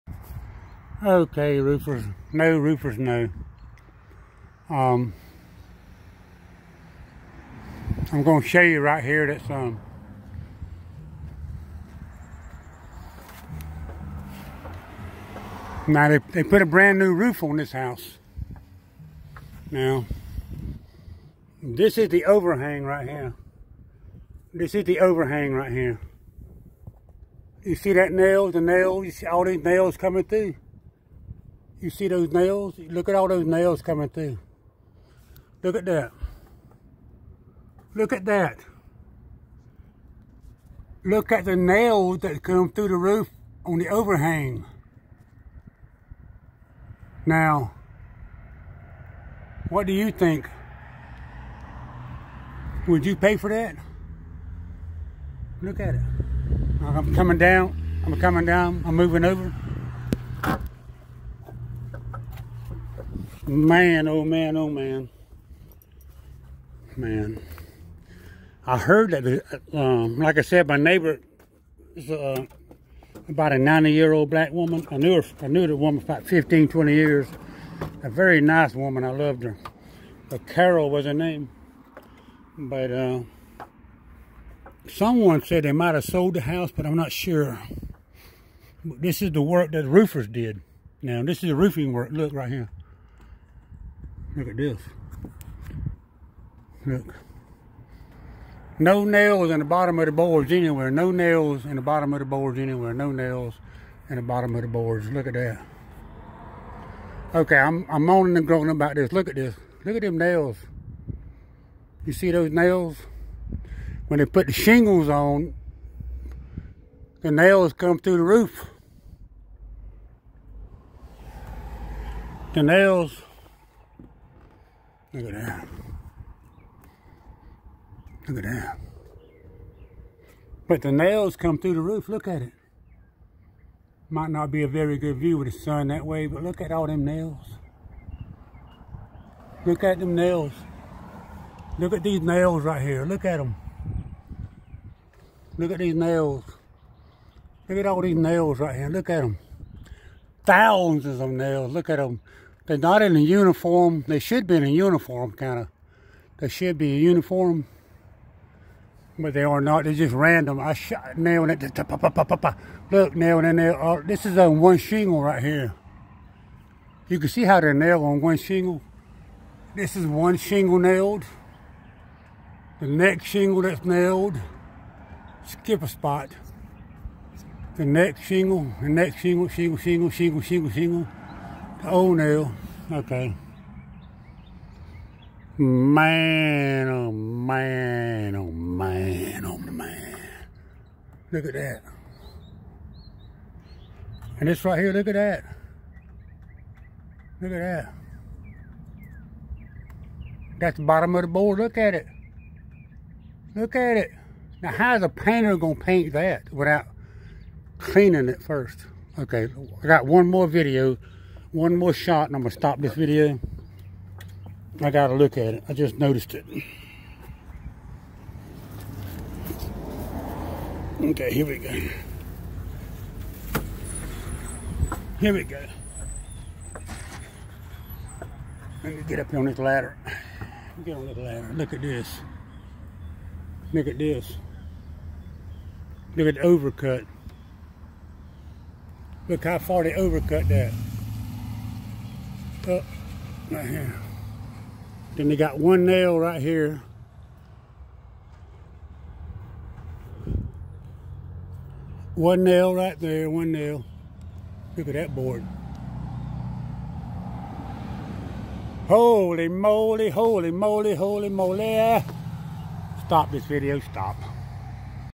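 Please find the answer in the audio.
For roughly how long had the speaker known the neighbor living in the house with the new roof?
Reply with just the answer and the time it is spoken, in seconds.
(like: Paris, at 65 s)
15, 20 years, at 76 s.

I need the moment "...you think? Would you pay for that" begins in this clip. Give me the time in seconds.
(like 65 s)
49 s.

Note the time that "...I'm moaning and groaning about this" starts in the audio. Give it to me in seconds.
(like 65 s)
107 s.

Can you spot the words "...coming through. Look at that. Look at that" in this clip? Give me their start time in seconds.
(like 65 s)
33 s.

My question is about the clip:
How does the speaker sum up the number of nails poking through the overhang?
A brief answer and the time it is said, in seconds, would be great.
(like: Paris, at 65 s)
Thousands, at 150 s.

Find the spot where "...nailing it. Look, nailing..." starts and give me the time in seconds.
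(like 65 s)
161 s.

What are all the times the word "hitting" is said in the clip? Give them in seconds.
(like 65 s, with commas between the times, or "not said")
not said.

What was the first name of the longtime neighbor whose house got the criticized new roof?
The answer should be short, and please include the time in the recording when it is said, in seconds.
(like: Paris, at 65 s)
Carol, at 80 s.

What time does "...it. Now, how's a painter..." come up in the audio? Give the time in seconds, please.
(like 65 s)
203 s.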